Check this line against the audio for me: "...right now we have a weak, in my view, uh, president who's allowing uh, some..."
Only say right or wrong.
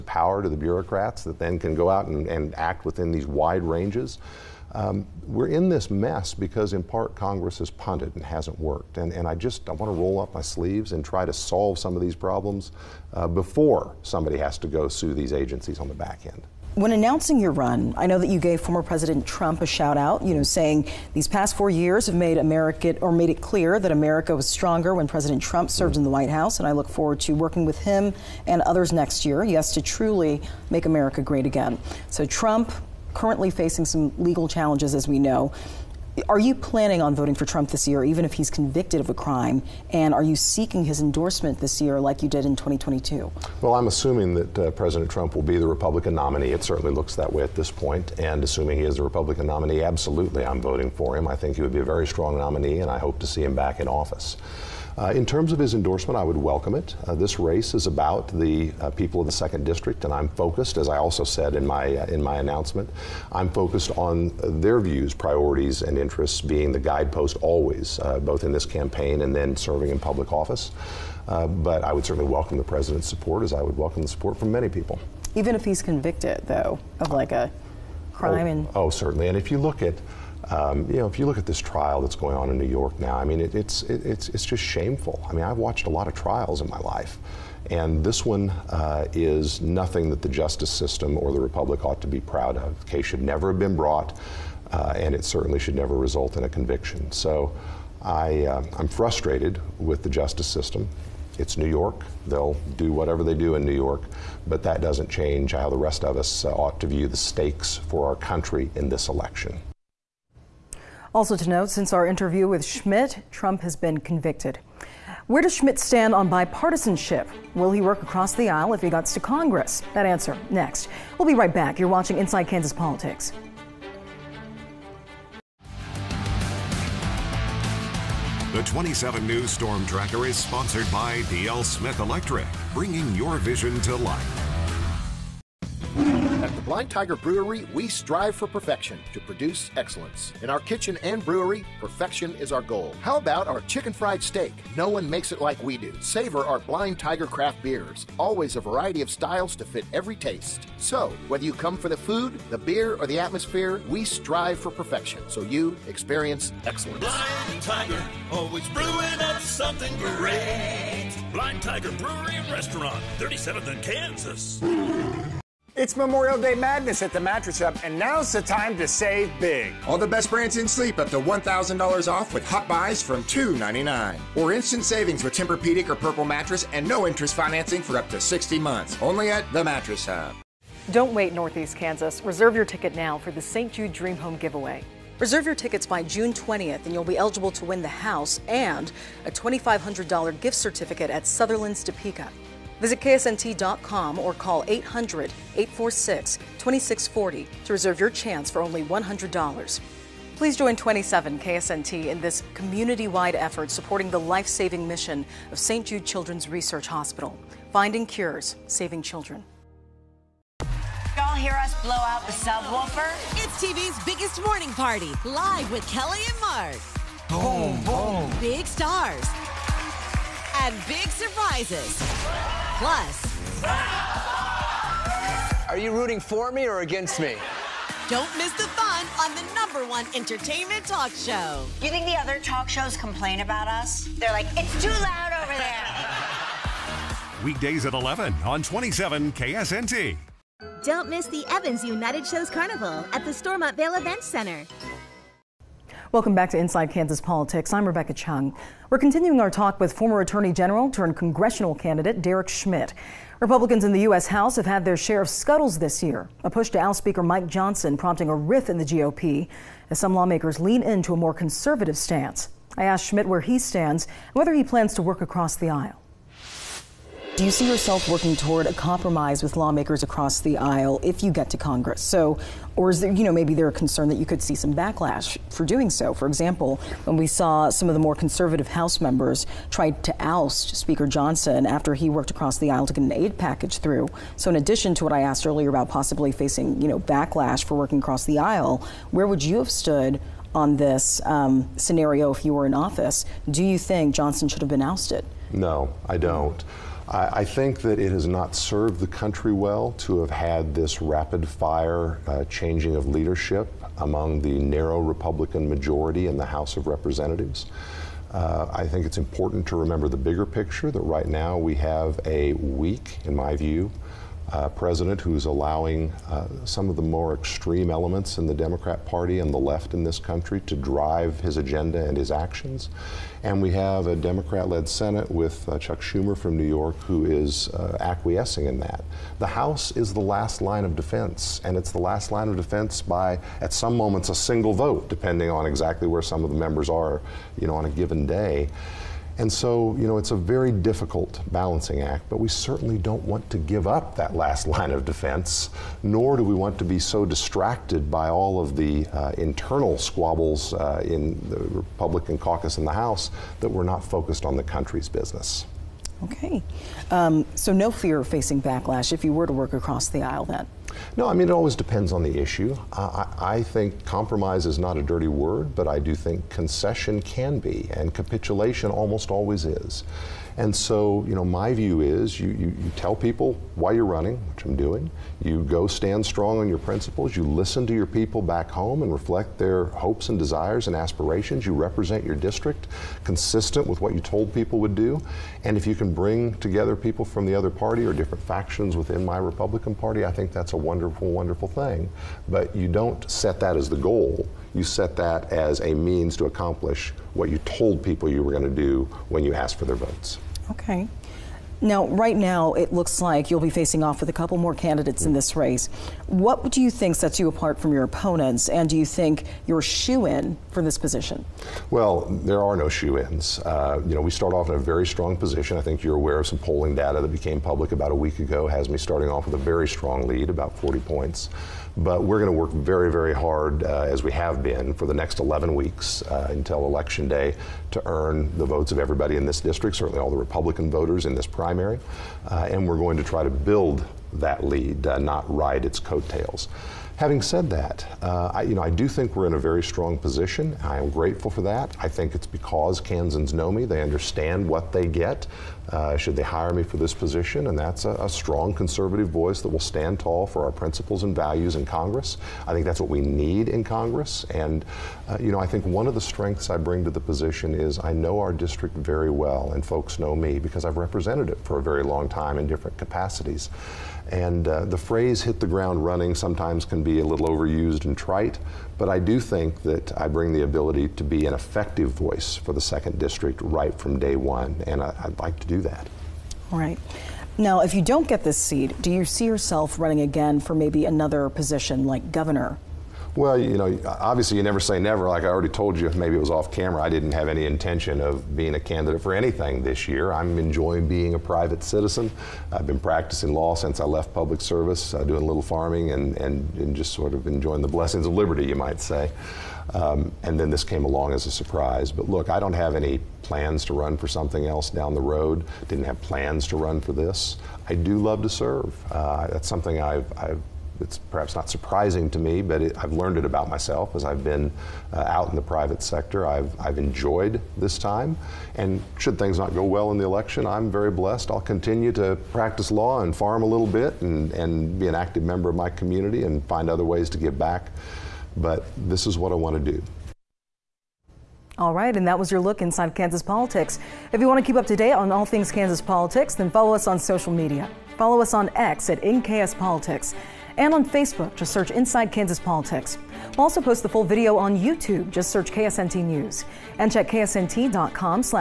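right.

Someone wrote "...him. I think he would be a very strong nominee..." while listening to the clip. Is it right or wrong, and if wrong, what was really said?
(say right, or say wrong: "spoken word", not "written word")
right.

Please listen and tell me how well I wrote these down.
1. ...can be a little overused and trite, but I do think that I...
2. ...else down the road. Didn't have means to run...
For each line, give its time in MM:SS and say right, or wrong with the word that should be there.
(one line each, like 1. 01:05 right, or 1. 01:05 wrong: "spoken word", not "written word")
1. 07:46 right
2. 08:24 wrong: "plans", not "means".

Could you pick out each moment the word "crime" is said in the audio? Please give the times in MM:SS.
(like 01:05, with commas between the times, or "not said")
00:39, 01:18.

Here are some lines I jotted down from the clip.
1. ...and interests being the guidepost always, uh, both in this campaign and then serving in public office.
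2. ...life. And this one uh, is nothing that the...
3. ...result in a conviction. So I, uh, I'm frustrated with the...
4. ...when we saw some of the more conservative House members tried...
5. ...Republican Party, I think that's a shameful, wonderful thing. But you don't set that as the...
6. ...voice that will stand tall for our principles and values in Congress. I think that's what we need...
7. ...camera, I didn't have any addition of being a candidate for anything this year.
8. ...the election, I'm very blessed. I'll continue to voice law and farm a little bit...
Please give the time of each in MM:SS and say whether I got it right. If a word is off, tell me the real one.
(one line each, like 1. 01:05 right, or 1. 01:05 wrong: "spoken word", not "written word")
1. 01:05 right
2. 01:26 right
3. 01:35 right
4. 04:37 right
5. 06:29 wrong: "wonderful", not "shameful"
6. 07:29 right
7. 08:06 wrong: "intention", not "addition"
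8. 08:40 wrong: "practice", not "voice".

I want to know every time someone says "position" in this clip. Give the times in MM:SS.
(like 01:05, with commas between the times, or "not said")
06:50, 06:55, 07:20, 07:27, 07:37, 08:01.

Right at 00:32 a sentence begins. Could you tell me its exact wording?
So Trump currently facing some legal challenges, as we know.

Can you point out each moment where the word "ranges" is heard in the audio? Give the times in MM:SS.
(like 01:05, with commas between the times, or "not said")
00:03.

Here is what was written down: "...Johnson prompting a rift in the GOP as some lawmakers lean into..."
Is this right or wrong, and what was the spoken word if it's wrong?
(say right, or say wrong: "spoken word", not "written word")
right.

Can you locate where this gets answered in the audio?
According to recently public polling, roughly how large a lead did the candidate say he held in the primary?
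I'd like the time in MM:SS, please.
07:00.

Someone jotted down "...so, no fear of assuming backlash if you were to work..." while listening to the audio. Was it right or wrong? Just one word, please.
wrong.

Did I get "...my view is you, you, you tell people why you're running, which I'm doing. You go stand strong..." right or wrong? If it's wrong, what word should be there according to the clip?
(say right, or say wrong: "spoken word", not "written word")
right.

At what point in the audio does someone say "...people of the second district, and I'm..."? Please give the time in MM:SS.
00:58.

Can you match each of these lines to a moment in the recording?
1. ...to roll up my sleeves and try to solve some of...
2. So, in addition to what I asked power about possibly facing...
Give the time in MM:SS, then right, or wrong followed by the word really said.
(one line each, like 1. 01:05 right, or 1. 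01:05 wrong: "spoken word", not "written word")
1. 00:09 right
2. 04:44 wrong: "earlier", not "power".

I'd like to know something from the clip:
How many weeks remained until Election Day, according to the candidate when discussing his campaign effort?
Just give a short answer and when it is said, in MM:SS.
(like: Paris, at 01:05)
11 weeks, at 07:05.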